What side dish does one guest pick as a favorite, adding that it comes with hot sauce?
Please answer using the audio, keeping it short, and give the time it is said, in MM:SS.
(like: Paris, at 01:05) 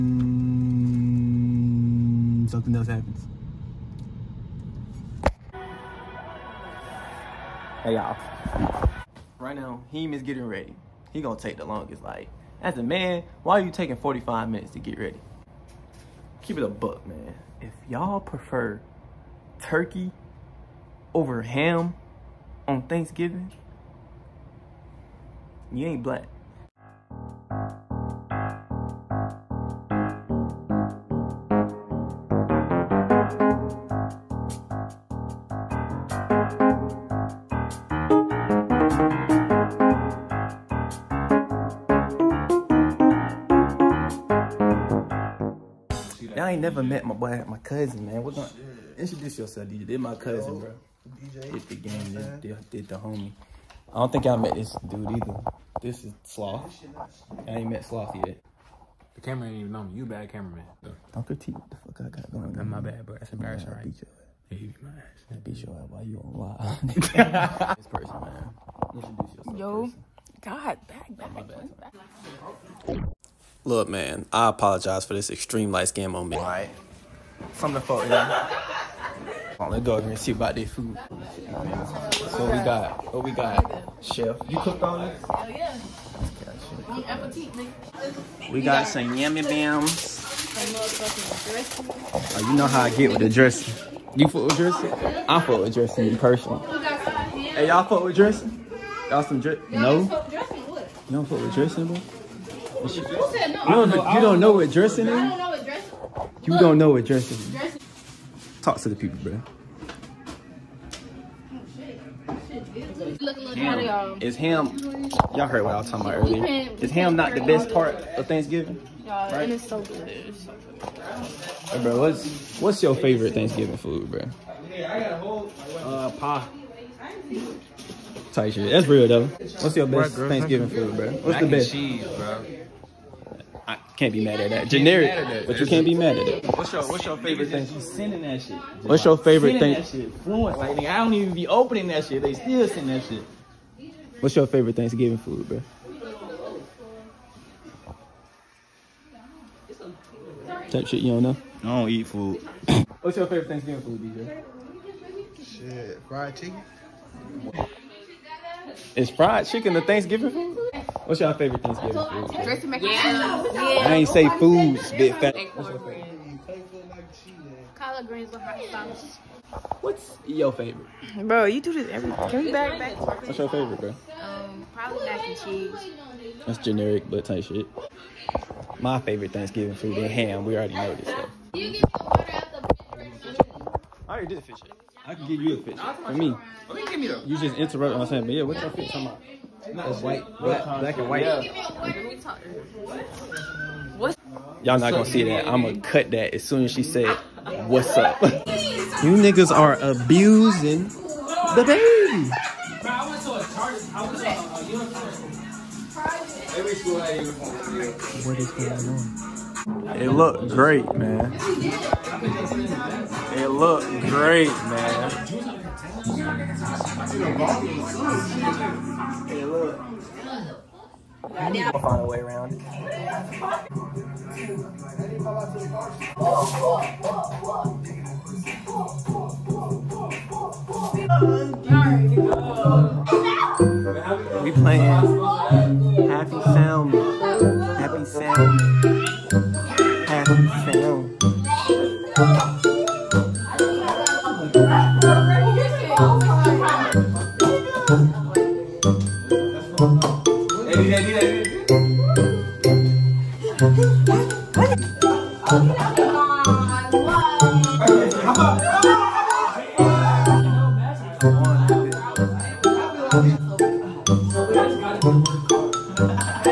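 Collard greens, at 02:47.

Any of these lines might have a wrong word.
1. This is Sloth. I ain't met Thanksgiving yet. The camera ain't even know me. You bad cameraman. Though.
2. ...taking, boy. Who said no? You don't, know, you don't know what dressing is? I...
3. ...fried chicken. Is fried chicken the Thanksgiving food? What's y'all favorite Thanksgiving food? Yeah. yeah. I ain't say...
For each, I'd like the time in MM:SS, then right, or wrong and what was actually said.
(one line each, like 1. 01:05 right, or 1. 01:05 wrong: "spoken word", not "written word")
1. 00:55 wrong: "Sloth", not "Thanksgiving"
2. 01:41 wrong: "dressing", not "taking"
3. 02:36 right.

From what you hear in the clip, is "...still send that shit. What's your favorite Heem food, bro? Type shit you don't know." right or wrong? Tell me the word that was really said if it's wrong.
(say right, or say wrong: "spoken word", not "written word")
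wrong: "Thanksgiving", not "Heem".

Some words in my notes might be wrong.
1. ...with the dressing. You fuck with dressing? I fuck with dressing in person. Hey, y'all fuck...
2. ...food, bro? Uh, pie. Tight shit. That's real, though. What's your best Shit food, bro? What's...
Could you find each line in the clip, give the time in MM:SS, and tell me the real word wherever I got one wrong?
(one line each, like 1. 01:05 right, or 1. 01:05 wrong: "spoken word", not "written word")
1. 01:33 right
2. 02:03 wrong: "Thanksgiving", not "Shit".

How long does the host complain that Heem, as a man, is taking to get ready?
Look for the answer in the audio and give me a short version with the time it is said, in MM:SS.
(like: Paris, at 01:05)
45 minutes, at 00:13.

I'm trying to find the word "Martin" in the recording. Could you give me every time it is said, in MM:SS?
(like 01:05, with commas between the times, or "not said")
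not said.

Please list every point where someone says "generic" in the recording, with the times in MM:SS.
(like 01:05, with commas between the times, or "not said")
02:14, 02:56.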